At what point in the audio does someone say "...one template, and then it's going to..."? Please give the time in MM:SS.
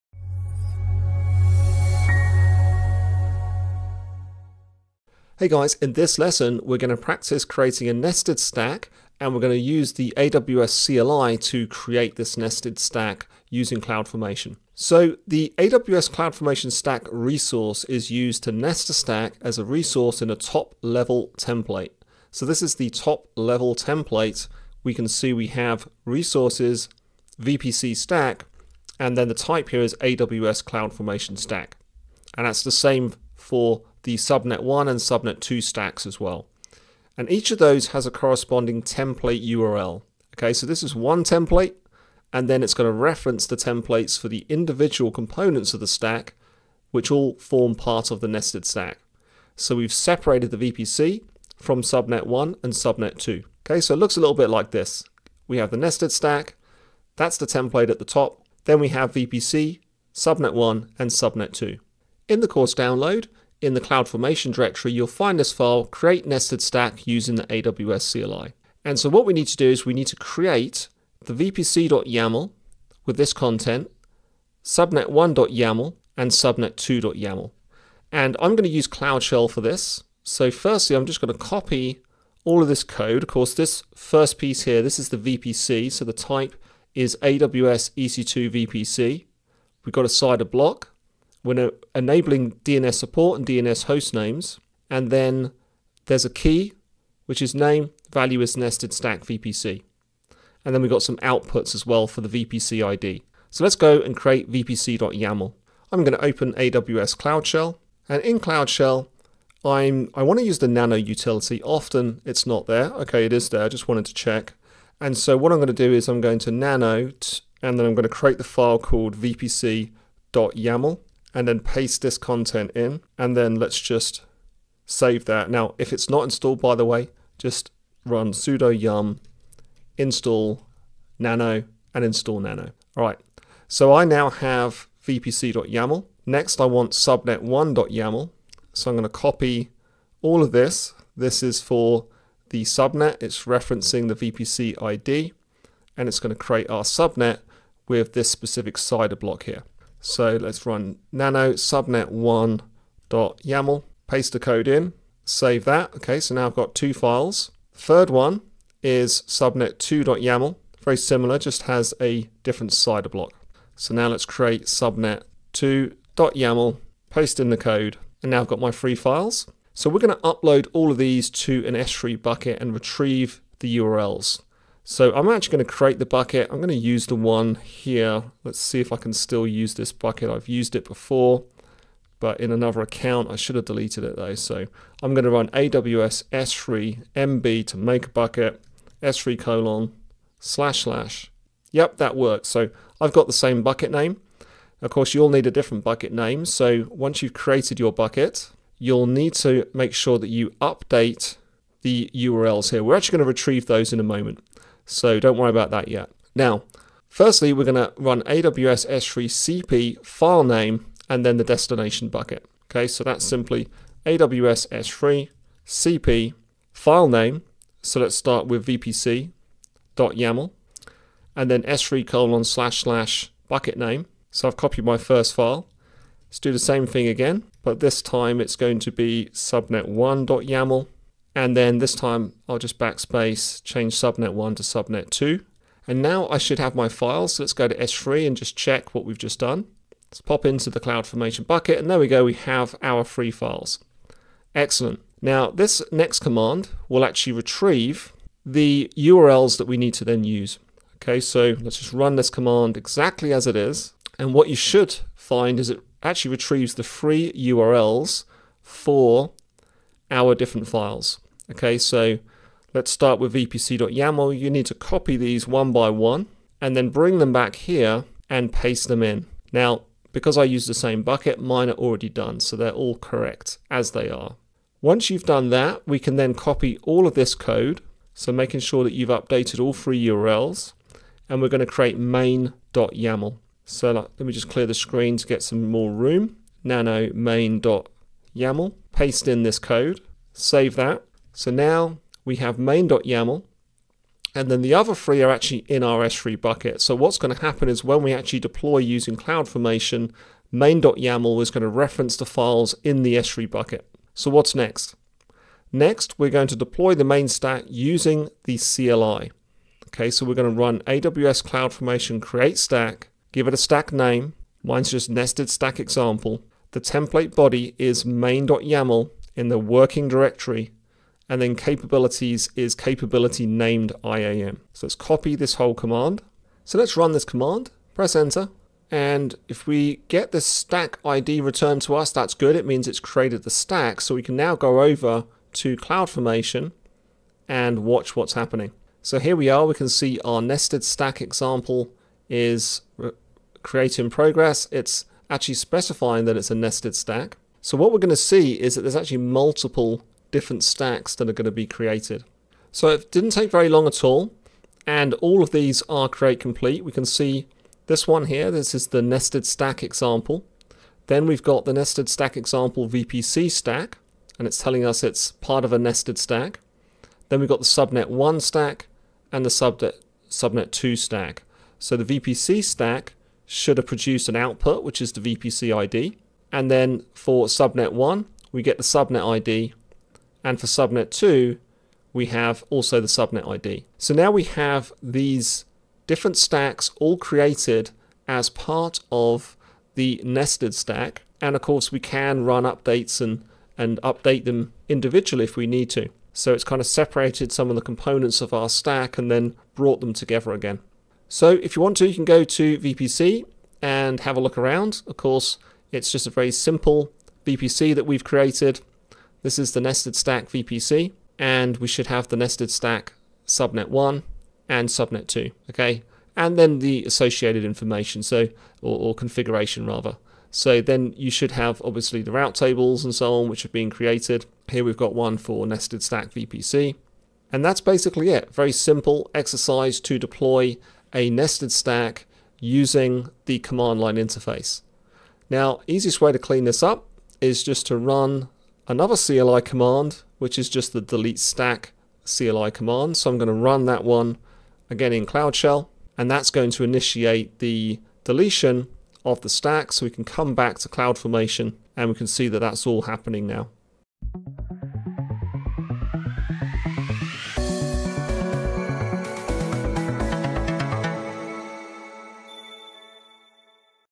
00:40.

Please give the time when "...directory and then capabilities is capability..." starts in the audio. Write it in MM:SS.
05:20.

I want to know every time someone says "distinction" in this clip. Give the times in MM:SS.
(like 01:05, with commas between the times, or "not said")
not said.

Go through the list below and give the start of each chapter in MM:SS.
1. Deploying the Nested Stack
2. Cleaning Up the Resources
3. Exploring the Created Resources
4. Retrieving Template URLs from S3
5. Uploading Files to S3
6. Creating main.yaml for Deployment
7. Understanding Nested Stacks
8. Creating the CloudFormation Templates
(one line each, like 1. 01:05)
1. 05:05
2. 07:16
3. 06:41
4. 04:05
5. 02:50
6. 04:34
7. 00:14
8. 01:02.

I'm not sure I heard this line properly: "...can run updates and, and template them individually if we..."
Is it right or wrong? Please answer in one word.
wrong.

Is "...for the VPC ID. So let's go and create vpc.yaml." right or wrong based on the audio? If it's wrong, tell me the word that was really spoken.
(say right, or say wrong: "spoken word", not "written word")
right.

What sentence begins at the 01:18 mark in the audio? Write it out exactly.
And I'm going to use Cloud Shell for this.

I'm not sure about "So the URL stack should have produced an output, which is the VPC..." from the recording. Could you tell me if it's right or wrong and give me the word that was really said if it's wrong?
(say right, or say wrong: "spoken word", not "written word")
wrong: "VPC", not "URL".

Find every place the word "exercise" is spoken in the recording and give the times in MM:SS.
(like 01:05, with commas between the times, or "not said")
07:09.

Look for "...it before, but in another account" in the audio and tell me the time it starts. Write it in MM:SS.
03:00.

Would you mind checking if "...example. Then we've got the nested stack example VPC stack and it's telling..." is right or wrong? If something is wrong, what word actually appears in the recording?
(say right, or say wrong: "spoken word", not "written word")
right.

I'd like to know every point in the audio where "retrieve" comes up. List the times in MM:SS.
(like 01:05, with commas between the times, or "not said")
02:52, 03:23, 04:07, 04:16.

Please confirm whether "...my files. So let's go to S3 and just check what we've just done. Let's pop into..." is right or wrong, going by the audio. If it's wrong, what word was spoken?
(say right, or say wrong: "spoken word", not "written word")
right.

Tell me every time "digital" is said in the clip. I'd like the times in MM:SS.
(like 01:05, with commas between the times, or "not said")
not said.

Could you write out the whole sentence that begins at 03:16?
So once you've created your bucket, you'll need to make sure that you update the URLs here.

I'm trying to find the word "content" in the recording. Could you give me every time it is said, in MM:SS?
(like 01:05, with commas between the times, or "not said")
01:13, 02:02.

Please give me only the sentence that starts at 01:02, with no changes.
In the course download, in the CloudFormation directory, you'll find this file, create nested stack using the AWS CLI.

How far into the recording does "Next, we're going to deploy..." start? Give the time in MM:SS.
05:05.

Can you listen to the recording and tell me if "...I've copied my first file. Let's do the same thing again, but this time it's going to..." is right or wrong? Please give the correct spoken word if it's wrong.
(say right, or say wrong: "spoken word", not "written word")
right.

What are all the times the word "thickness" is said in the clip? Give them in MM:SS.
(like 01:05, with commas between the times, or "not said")
not said.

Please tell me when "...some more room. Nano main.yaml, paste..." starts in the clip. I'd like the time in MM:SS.
04:45.